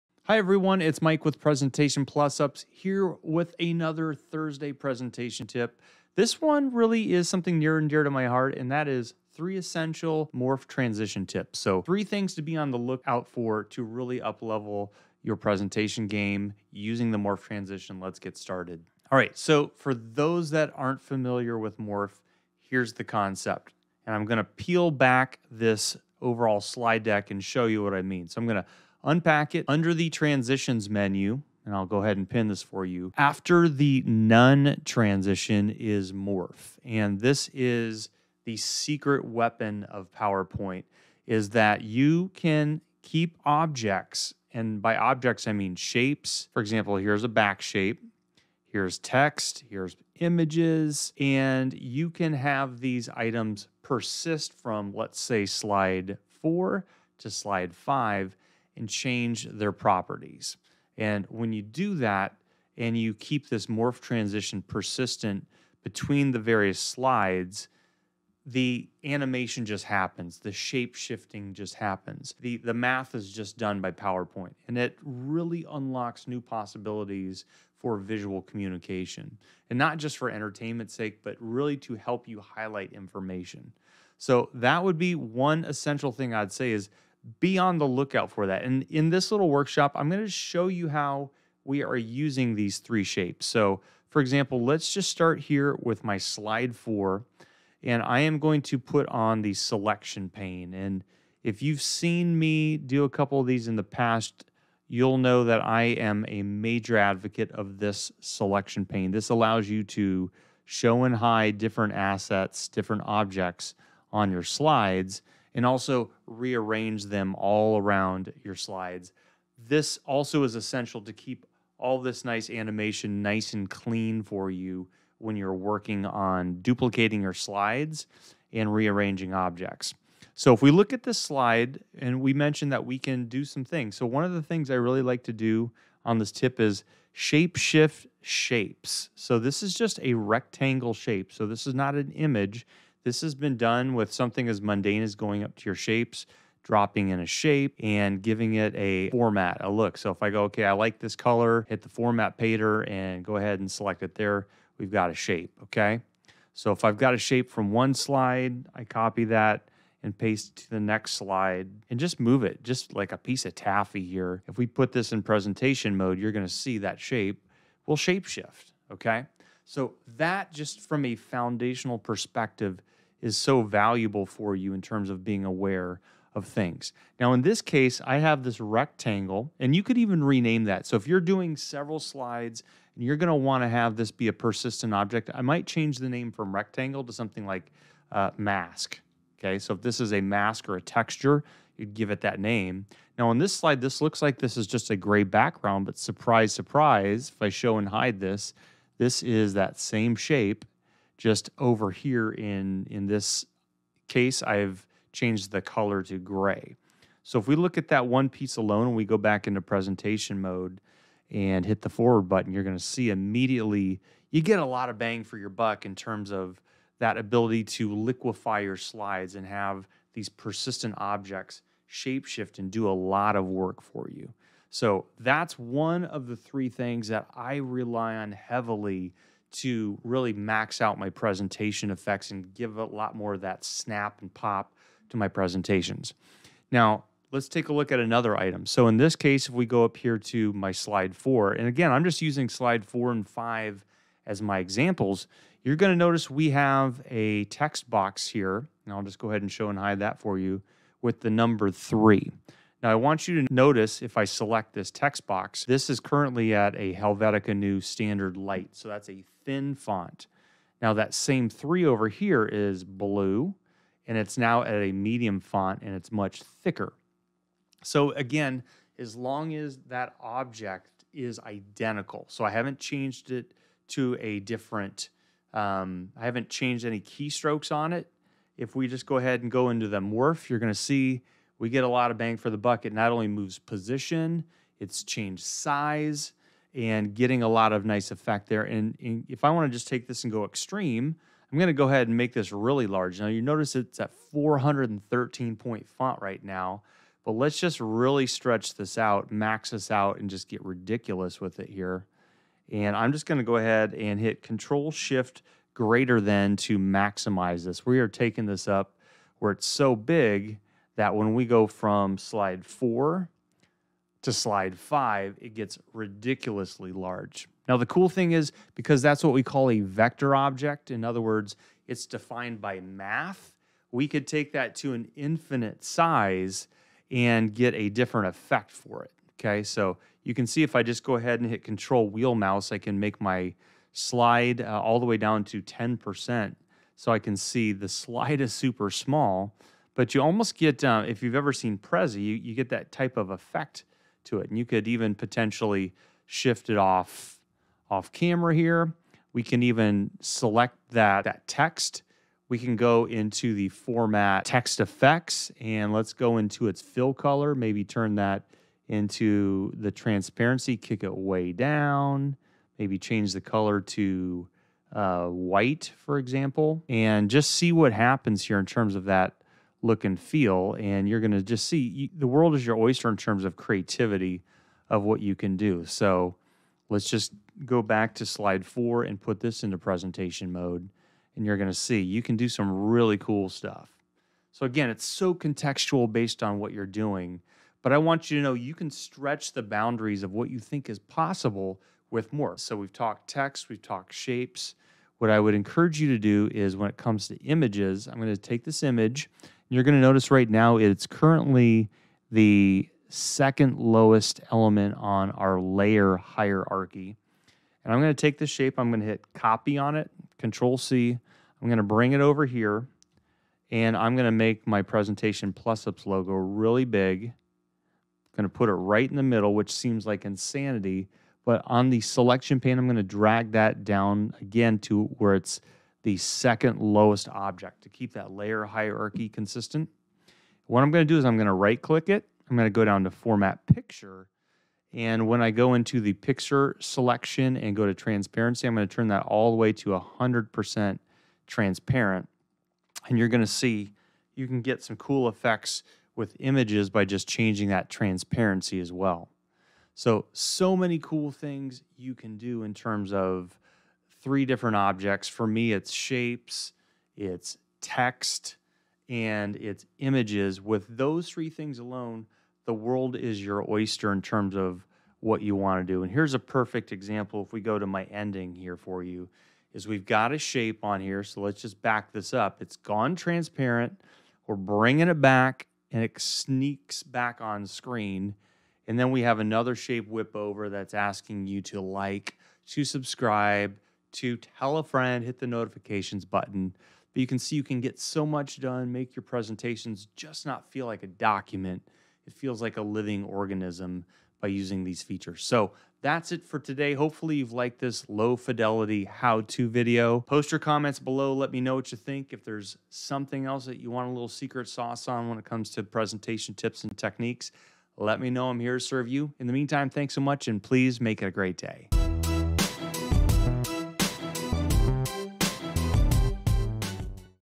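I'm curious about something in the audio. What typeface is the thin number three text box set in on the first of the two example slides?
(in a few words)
Helvetica Neue Standard Light.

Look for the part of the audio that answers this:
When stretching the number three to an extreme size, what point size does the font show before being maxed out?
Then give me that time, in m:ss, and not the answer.
4:54.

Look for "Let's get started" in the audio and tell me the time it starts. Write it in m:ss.
0:17.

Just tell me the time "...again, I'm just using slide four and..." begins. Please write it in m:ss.
4:01.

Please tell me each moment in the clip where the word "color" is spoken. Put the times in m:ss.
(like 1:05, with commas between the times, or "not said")
2:31, 3:25, 5:57, 6:03.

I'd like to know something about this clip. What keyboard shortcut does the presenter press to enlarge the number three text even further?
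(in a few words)
Control Shift greater than.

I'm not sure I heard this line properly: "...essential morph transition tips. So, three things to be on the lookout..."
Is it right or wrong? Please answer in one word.
right.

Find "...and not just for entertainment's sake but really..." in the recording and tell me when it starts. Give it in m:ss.
1:19.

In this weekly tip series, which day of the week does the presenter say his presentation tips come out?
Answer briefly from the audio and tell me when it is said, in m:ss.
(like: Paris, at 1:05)
Thursday, at 0:04.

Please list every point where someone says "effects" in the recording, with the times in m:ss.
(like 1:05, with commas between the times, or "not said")
3:51, 4:48, 5:28, 5:43, 5:54, 7:25.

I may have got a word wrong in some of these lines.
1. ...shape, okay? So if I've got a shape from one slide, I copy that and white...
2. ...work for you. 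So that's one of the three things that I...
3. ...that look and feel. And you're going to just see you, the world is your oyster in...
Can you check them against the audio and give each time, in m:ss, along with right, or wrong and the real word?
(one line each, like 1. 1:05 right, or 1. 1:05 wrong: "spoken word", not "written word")
1. 2:35 wrong: "paste", not "white"
2. 3:43 right
3. 6:09 right.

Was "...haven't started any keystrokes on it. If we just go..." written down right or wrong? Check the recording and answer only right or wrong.
wrong.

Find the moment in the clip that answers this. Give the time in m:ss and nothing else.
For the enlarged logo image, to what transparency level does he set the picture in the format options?
7:19.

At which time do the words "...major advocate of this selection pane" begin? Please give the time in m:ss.
1:46.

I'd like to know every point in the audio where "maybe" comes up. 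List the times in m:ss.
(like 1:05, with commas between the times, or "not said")
5:57, 6:02.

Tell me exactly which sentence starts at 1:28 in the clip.
And in this little workshop, I'm going to show you how we are using these three shapes.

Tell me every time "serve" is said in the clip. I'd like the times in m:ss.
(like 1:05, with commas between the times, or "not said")
8:28.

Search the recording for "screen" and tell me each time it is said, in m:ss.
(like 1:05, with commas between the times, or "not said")
7:57.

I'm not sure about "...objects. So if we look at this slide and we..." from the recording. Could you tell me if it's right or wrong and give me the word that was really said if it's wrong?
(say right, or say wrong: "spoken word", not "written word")
right.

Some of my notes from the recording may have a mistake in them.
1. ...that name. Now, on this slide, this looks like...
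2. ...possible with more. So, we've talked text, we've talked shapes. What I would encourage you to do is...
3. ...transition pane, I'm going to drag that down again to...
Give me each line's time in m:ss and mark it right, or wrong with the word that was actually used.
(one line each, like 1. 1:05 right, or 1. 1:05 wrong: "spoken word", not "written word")
1. 3:12 right
2. 6:30 right
3. 7:02 wrong: "selection", not "transition".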